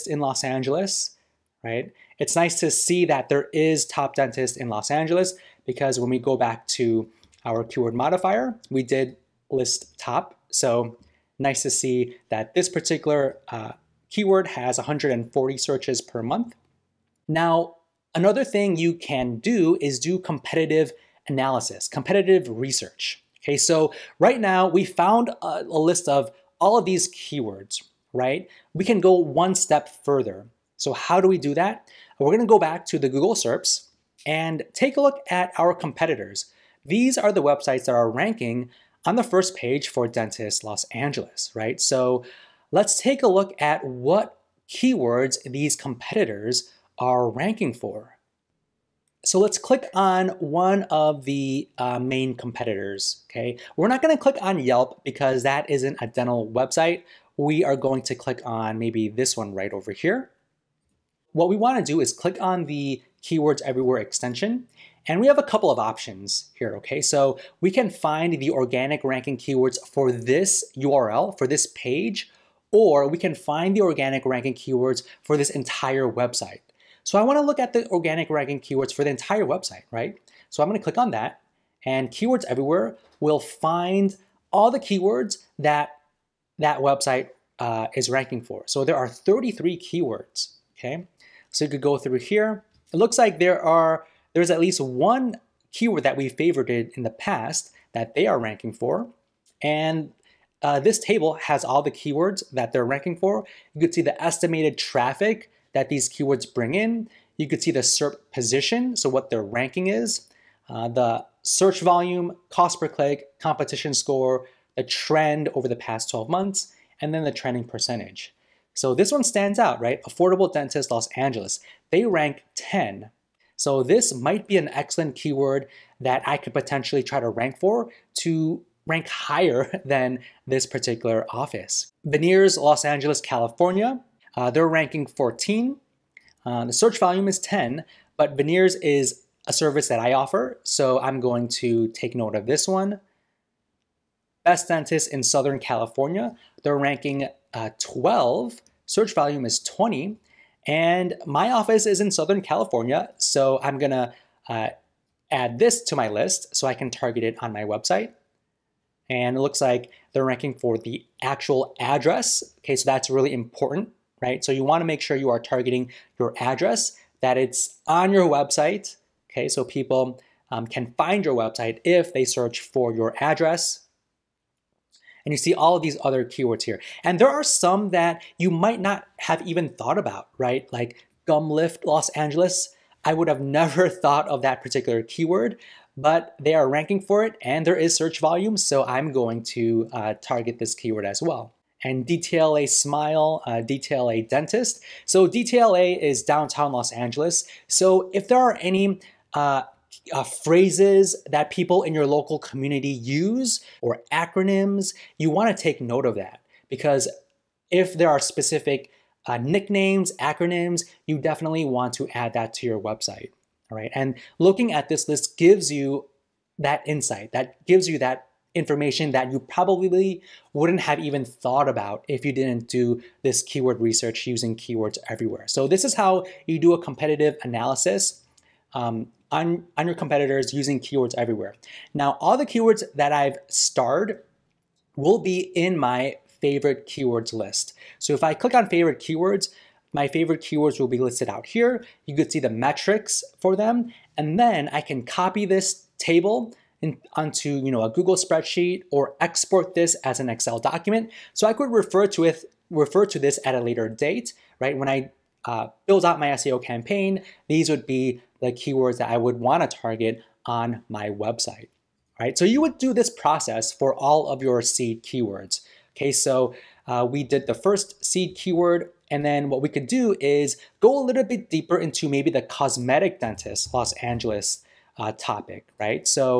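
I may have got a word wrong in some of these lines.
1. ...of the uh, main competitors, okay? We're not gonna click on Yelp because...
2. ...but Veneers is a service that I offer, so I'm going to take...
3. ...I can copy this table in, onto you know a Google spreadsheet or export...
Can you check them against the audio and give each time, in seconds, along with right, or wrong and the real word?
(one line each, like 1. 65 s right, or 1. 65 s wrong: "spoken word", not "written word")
1. 50 s right
2. 138 s right
3. 244 s right.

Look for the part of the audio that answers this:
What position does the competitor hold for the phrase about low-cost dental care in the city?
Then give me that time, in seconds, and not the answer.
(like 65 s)
121 s.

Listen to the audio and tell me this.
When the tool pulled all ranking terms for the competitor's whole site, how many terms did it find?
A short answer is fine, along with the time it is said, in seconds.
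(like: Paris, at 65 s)
33, at 89 s.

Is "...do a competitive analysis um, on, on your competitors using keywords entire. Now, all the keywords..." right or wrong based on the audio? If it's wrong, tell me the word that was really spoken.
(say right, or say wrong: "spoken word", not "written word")
wrong: "everywhere", not "entire".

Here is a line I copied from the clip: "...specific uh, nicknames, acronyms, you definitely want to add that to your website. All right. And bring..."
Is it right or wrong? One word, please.
wrong.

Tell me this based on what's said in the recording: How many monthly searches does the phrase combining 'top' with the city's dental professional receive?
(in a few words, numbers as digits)
140.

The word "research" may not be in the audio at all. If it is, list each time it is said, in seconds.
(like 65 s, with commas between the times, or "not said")
22 s, 223 s.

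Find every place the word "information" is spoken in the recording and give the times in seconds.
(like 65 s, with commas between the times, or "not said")
218 s.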